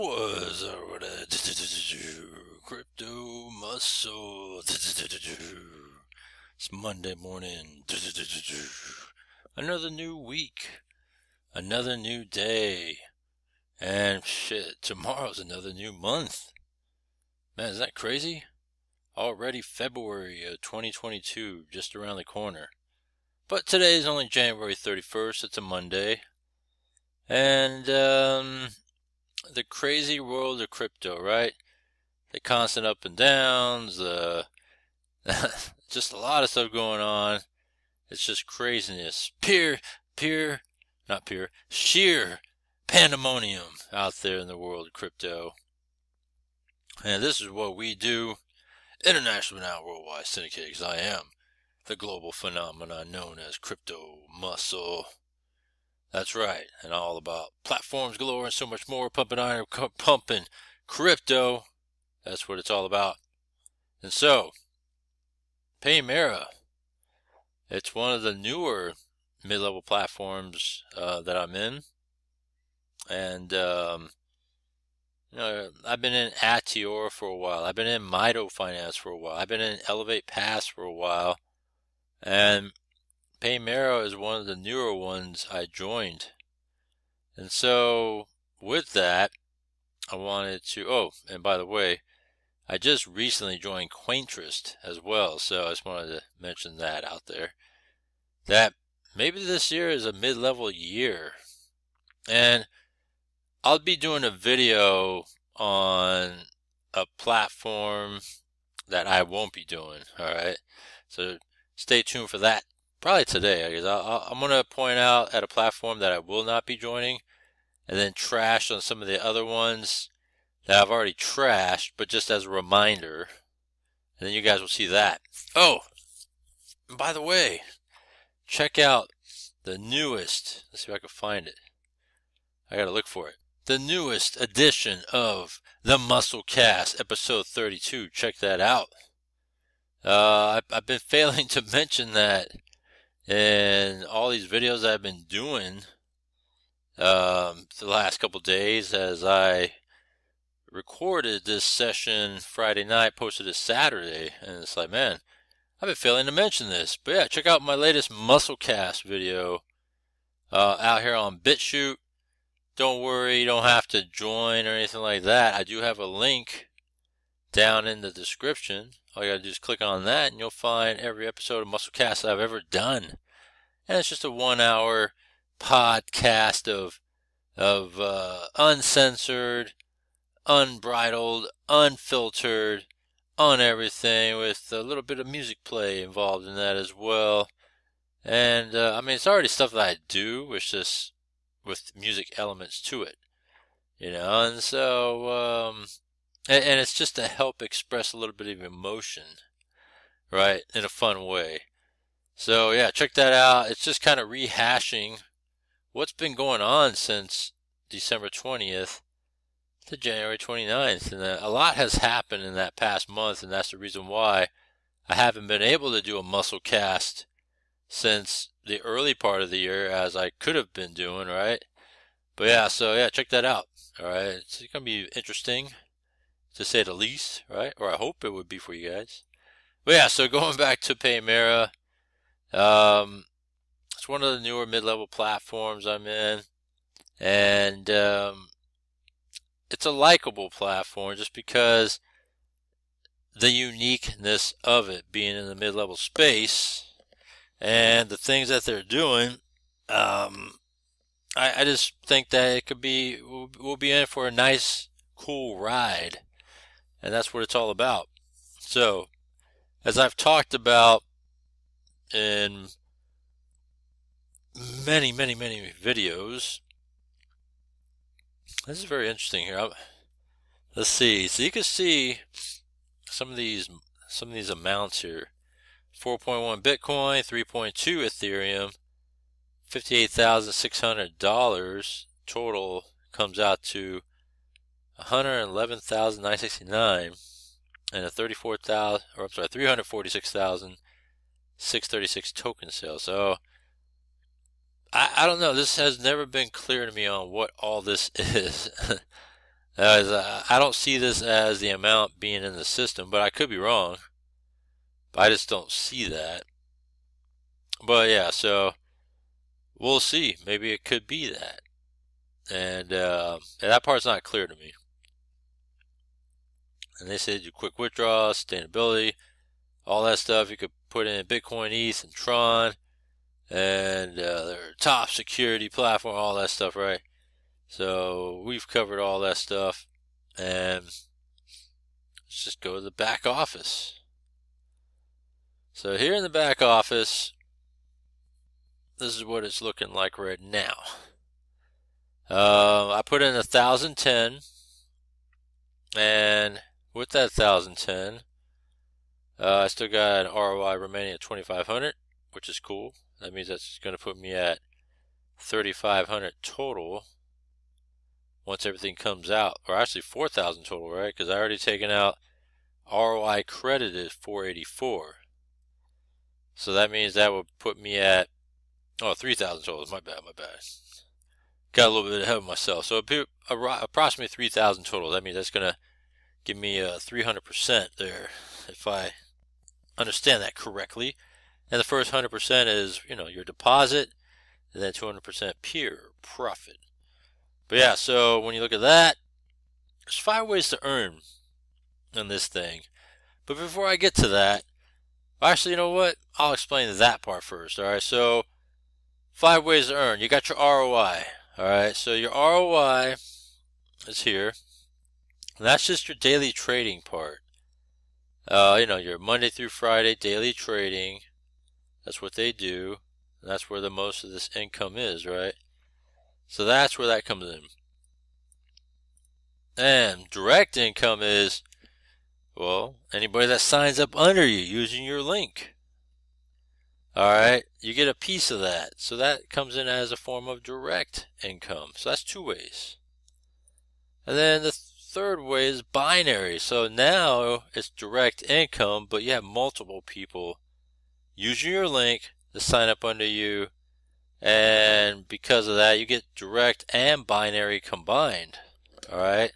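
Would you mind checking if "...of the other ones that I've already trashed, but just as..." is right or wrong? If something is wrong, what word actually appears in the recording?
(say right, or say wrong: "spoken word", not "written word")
right.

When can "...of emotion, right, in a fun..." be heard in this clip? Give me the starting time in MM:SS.
03:18.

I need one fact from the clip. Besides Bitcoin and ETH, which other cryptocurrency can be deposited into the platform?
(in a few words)
Tron.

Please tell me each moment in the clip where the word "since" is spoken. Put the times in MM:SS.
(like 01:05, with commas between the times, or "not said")
03:26, 03:37.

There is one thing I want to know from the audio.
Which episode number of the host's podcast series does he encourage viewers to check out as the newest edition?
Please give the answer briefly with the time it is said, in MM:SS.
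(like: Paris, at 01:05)
32, at 02:16.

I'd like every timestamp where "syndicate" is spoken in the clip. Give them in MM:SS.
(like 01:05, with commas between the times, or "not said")
00:50.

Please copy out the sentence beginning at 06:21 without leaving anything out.
And the first 100% is, you know, your deposit, and then 200% pure profit.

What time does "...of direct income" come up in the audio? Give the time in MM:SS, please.
07:10.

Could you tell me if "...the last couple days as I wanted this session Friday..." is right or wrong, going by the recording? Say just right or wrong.
wrong.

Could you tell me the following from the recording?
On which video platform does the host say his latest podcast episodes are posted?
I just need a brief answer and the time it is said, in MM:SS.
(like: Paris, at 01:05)
BitChute, at 02:41.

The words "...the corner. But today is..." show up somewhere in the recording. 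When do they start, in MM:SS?
00:22.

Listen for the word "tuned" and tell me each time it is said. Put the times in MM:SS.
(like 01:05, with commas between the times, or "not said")
01:52.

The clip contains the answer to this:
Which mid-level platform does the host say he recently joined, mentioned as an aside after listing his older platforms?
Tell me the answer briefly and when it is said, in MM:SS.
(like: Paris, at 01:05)
Quaintrist, at 01:33.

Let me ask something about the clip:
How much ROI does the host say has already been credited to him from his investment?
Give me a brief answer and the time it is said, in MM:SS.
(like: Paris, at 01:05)
484, at 06:03.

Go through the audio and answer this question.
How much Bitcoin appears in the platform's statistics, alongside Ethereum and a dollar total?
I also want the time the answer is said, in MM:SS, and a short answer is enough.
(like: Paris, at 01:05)
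4.1 Bitcoin, at 04:35.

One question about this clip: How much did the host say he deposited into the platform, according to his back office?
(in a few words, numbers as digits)
1010.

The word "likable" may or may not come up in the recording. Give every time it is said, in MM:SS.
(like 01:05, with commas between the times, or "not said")
03:59.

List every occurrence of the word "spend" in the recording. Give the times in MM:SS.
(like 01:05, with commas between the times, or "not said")
not said.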